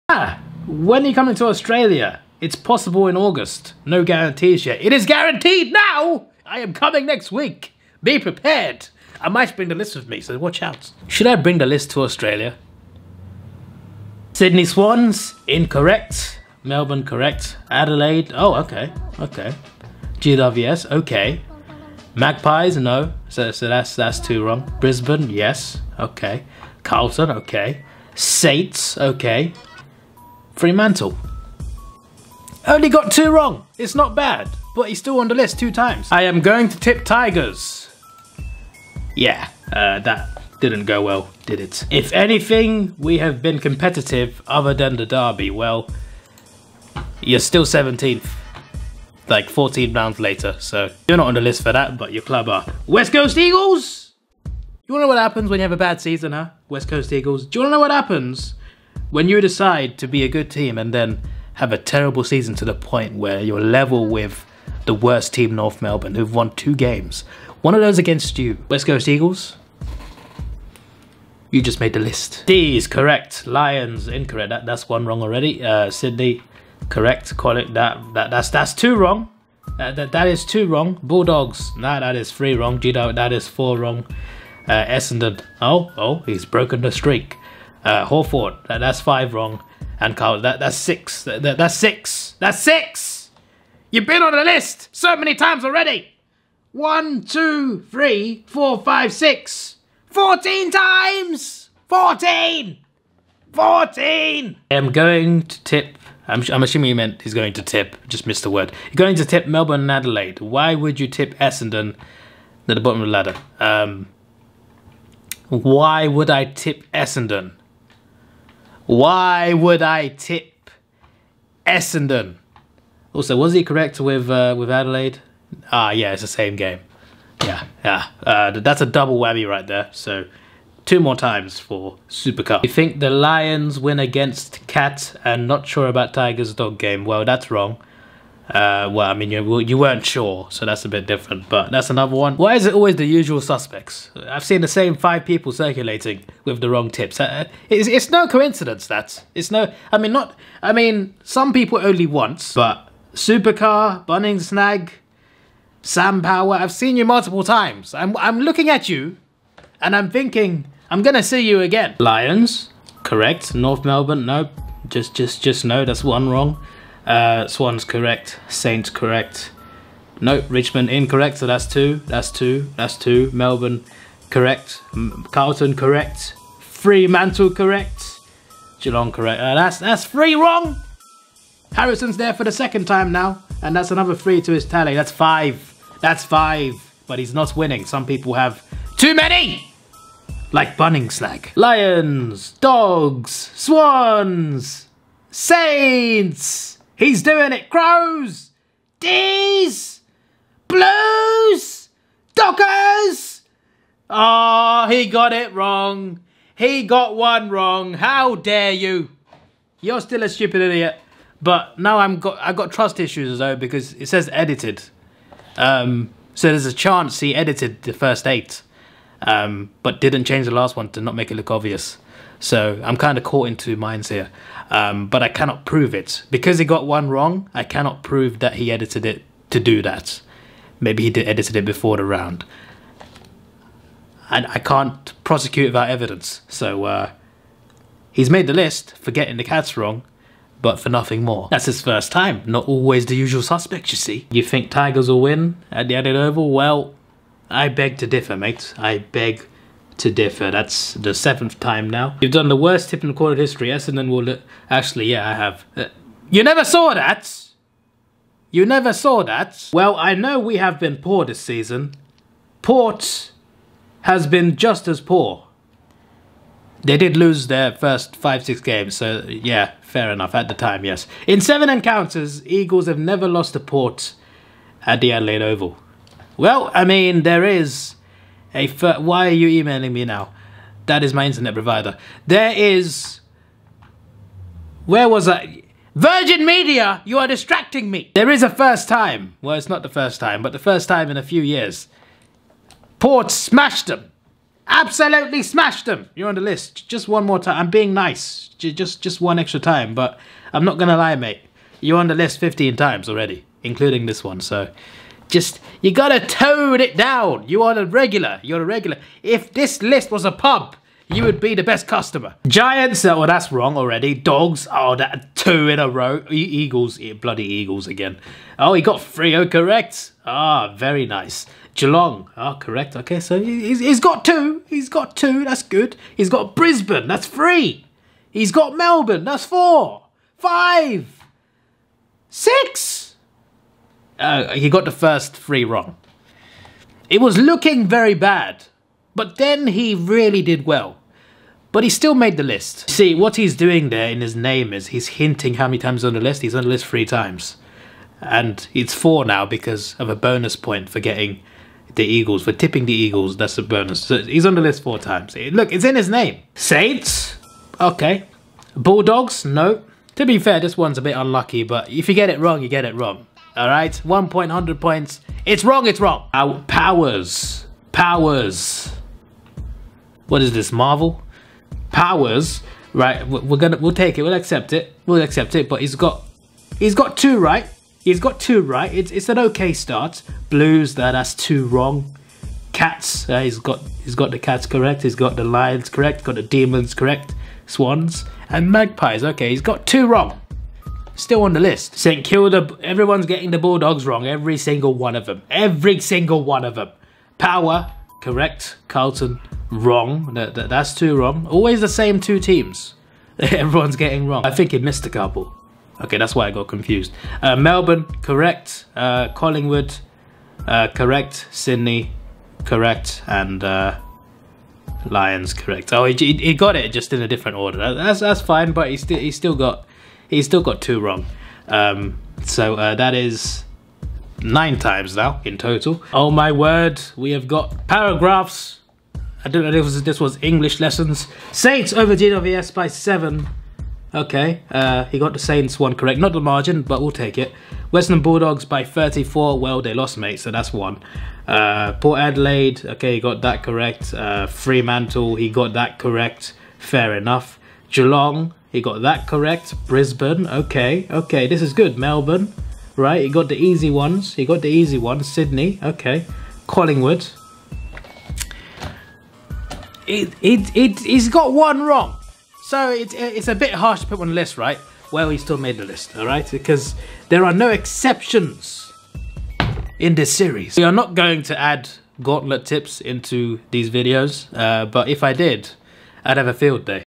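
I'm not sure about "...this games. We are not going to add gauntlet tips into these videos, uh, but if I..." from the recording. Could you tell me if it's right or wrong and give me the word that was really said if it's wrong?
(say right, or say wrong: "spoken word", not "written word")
wrong: "series", not "games".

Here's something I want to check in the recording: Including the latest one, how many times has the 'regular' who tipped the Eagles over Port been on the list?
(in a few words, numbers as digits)
15.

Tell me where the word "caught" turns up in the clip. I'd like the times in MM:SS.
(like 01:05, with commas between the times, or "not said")
03:43.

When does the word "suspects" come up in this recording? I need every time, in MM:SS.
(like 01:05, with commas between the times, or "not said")
02:23, 04:03.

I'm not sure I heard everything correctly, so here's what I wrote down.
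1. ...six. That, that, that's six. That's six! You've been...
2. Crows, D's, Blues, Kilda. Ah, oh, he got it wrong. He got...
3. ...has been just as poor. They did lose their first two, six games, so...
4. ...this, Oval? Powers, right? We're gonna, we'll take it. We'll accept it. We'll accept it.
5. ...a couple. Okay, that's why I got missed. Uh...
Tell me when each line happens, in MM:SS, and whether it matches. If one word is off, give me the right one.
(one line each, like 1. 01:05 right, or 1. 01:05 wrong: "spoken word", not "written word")
1. 01:30 right
2. 03:17 wrong: "Dockers", not "Kilda"
3. 04:24 wrong: "five", not "two"
4. 06:10 wrong: "Marvel", not "Oval"
5. 06:45 wrong: "confused", not "missed".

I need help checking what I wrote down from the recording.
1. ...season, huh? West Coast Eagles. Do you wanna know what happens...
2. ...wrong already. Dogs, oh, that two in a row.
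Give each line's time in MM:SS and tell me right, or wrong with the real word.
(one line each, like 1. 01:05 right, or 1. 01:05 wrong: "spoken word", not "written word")
1. 00:56 right
2. 05:13 right.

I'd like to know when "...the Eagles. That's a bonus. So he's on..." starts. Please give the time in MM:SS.
05:52.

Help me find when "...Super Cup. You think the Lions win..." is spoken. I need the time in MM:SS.
02:12.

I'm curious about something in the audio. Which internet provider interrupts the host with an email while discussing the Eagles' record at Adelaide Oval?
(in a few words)
Virgin Media.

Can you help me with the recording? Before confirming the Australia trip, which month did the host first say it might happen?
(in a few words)
August.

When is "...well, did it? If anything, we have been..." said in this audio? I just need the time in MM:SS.
00:41.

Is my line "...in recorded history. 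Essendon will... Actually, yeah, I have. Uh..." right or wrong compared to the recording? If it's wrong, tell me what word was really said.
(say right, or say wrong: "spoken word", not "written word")
right.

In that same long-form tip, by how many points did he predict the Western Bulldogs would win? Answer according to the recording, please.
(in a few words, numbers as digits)
34.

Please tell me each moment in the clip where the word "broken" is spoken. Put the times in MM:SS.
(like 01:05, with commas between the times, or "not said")
01:26.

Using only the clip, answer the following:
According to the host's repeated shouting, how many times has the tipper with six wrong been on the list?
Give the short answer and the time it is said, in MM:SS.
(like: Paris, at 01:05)
14, at 01:40.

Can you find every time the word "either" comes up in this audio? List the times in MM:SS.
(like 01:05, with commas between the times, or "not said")
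not said.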